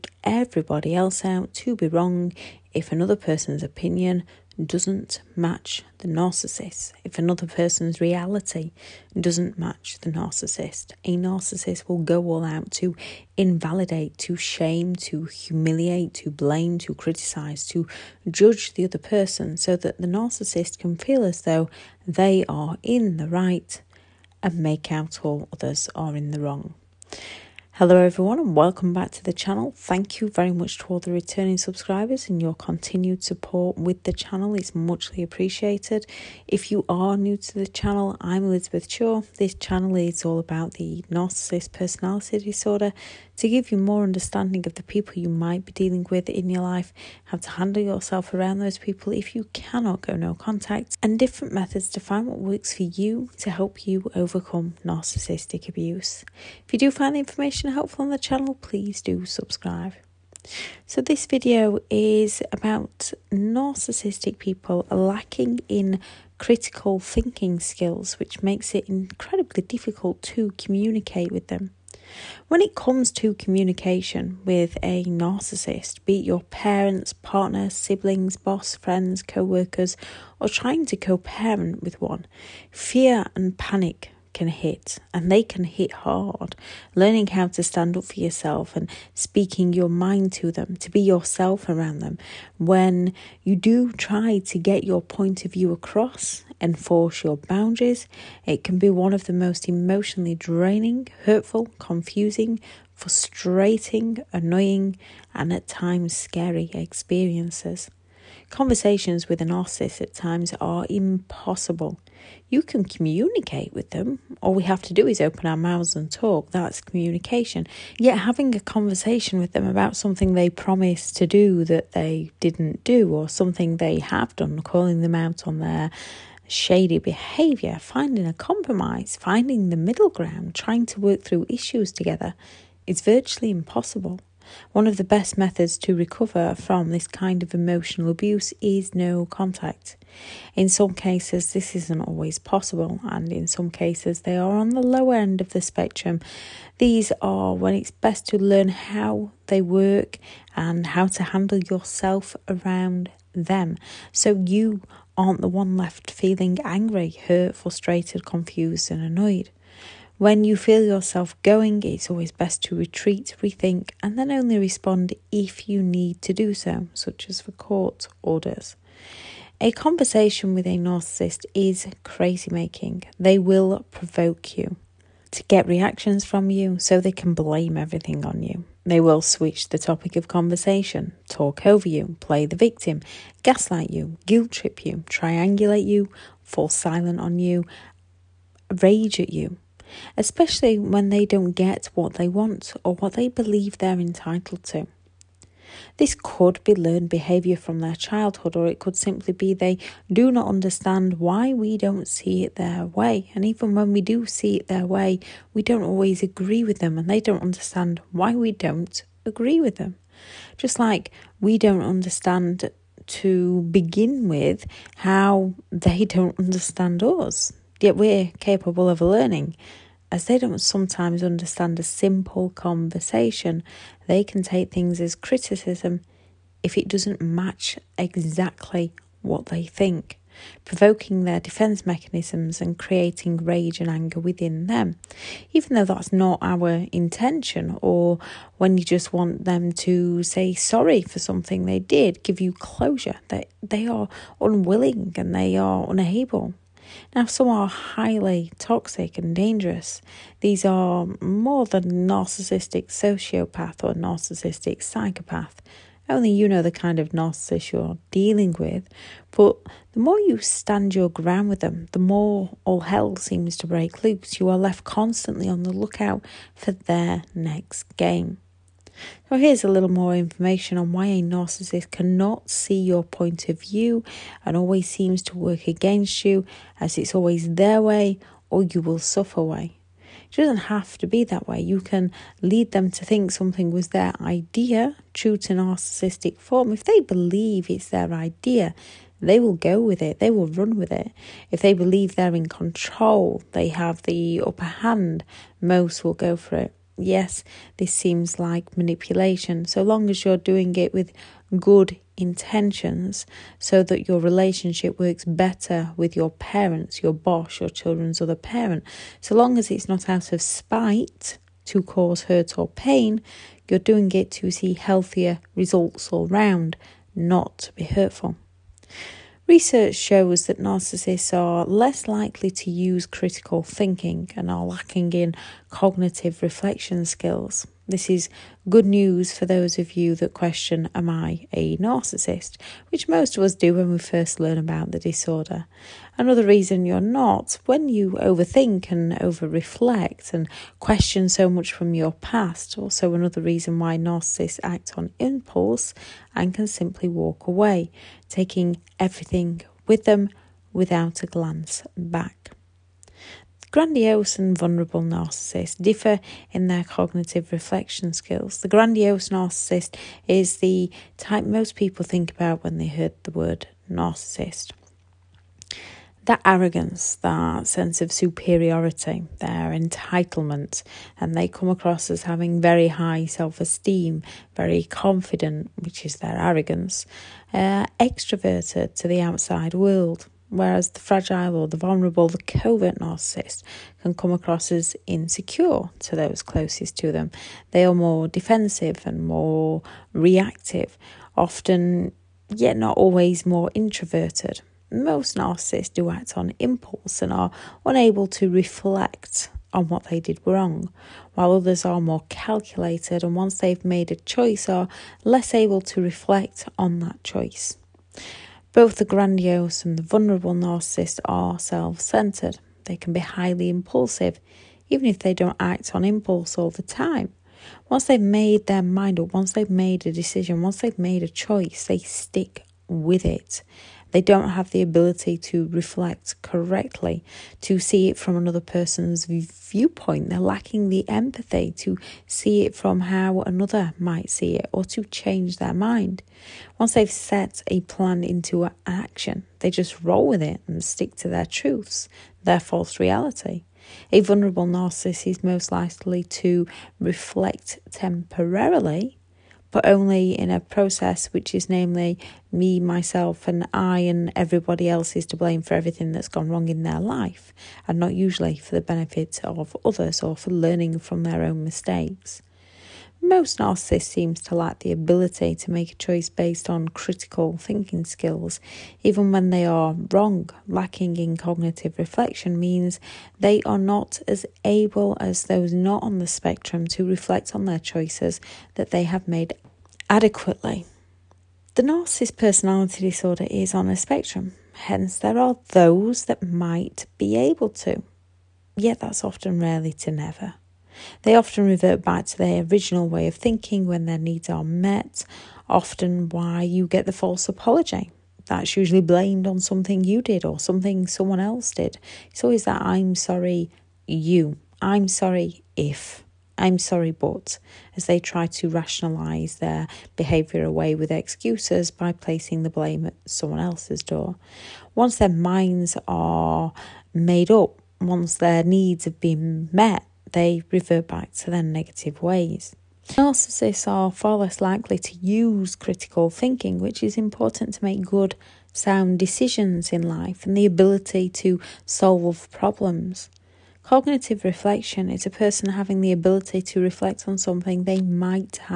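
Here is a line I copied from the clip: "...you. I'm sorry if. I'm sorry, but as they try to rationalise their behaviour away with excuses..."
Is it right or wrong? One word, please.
right.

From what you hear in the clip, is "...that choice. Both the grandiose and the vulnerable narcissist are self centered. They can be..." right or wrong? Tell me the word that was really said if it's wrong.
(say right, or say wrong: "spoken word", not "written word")
right.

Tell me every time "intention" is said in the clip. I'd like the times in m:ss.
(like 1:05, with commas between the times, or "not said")
3:56, 5:02.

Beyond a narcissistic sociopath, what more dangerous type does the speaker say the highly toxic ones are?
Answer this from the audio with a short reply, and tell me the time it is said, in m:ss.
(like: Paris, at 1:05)
Narcissistic psychopath, at 4:13.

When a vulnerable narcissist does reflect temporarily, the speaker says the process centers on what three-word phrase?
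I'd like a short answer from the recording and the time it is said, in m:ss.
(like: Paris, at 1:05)
Me, myself, and I, at 7:32.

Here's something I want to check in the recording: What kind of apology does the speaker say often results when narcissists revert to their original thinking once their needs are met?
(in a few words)
The false apology.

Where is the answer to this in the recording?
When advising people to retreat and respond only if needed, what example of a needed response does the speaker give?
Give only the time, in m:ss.
2:47.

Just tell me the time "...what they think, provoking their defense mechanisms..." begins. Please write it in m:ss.
3:49.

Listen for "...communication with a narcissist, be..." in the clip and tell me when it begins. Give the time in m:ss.
1:13.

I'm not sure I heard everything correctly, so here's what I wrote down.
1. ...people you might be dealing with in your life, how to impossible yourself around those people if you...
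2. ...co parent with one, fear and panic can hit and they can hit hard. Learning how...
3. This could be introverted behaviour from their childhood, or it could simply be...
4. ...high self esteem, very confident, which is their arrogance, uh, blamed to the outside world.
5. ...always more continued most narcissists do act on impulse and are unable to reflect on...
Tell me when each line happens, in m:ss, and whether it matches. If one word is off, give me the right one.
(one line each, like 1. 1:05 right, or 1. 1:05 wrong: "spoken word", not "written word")
1. 0:44 wrong: "handle", not "impossible"
2. 1:20 right
3. 3:15 wrong: "learned", not "introverted"
4. 6:12 wrong: "extroverted", not "blamed"
5. 6:32 wrong: "introverted", not "continued".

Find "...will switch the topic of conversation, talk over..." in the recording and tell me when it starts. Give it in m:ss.
2:58.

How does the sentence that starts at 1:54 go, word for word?
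All we have to do is open our mouths and talk.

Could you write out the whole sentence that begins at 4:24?
You are left constantly on the lookout for their next game.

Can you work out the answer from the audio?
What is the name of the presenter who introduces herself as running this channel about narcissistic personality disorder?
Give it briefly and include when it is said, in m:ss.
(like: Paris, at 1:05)
Elizabeth Shaw, at 0:38.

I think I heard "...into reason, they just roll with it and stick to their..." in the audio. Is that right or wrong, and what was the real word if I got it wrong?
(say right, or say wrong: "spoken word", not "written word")
wrong: "action", not "reason".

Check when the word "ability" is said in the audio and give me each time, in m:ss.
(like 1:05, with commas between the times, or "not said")
7:04, 7:44, 8:50, 8:56.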